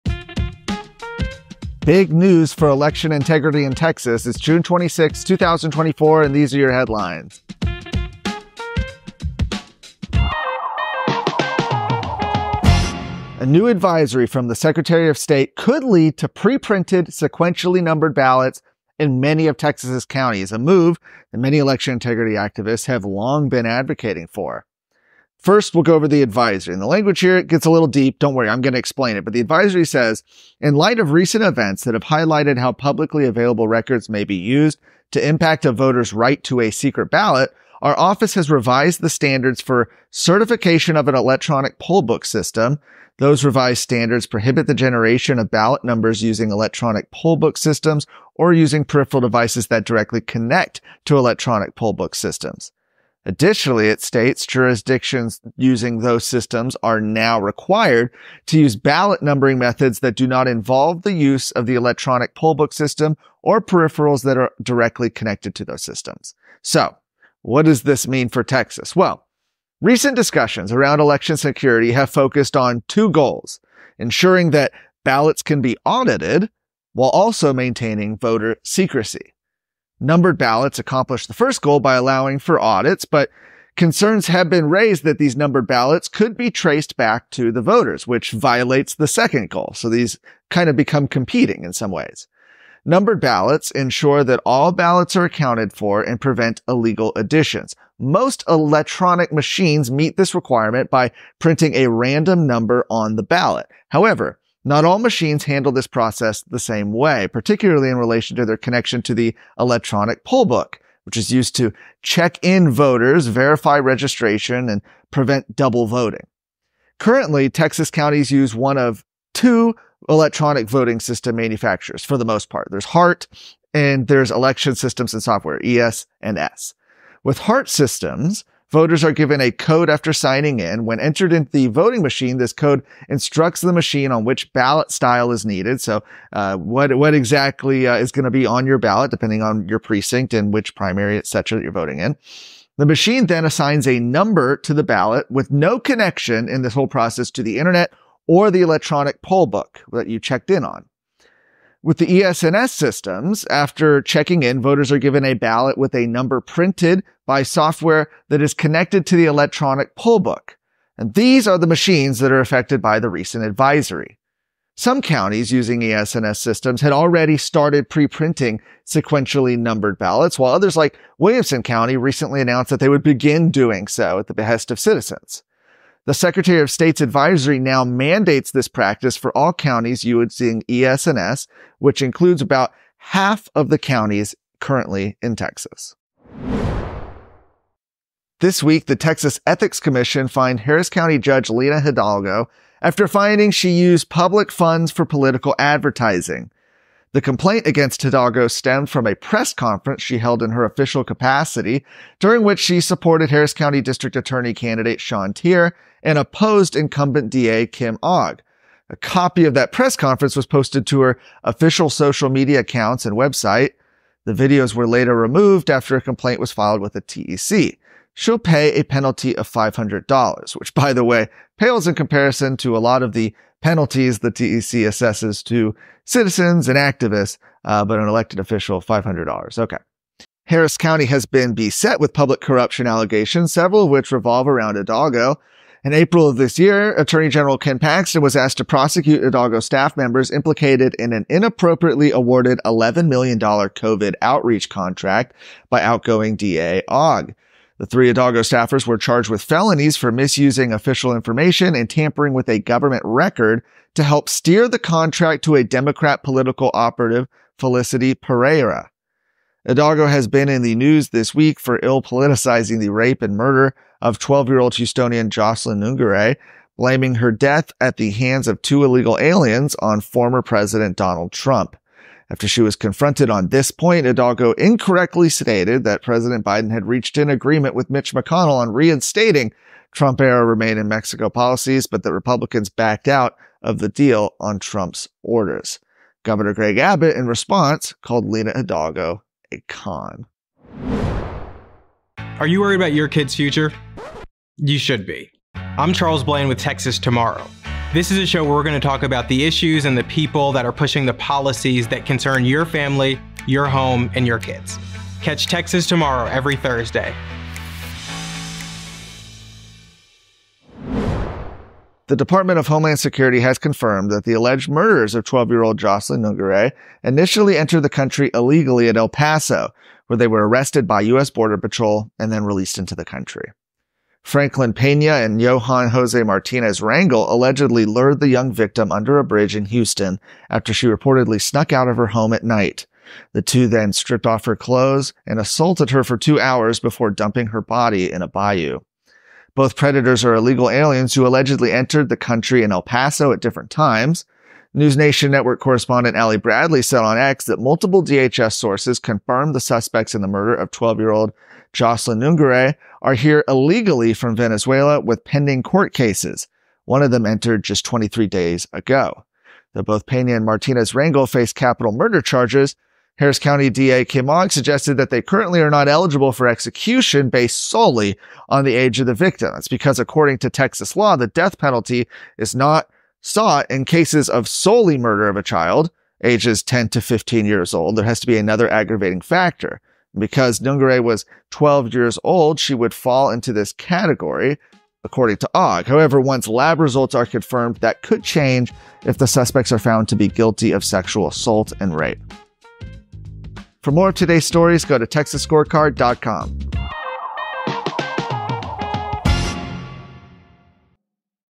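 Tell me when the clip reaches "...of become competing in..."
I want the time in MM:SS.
01:30.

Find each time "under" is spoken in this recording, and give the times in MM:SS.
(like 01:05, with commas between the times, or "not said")
05:28.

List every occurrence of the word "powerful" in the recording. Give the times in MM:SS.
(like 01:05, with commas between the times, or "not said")
not said.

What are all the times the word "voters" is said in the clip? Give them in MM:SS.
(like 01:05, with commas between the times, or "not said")
00:35, 01:18, 01:27, 01:52, 02:08, 02:34.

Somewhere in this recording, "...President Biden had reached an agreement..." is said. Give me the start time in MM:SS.
04:36.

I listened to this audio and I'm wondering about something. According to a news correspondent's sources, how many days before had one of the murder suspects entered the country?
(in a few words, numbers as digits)
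23 days.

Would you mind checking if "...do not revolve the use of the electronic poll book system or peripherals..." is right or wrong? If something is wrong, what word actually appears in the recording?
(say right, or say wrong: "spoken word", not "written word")
wrong: "involve", not "revolve".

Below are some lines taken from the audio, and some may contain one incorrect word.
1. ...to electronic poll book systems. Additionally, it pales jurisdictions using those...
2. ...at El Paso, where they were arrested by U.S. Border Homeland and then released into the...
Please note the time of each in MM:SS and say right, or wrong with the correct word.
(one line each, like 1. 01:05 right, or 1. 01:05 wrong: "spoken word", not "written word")
1. 00:51 wrong: "states", not "pales"
2. 05:18 wrong: "Patrol", not "Homeland".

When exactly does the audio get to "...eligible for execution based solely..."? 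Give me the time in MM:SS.
06:05.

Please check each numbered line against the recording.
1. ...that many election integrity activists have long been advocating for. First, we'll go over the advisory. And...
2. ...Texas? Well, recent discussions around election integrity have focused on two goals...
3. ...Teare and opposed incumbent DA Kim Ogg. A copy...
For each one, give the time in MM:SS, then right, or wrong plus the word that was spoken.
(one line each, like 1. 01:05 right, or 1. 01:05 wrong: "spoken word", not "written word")
1. 00:21 right
2. 01:08 wrong: "security", not "integrity"
3. 03:25 right.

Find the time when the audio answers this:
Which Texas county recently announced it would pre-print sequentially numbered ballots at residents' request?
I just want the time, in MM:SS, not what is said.
02:51.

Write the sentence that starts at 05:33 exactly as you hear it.
The two then stripped off her clothes and assaulted her for two hours before dumping her body in a bayou.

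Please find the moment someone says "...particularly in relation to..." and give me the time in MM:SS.
01:47.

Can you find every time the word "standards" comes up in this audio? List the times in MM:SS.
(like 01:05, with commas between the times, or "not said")
00:39, 00:43.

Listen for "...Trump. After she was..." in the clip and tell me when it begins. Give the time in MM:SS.
04:31.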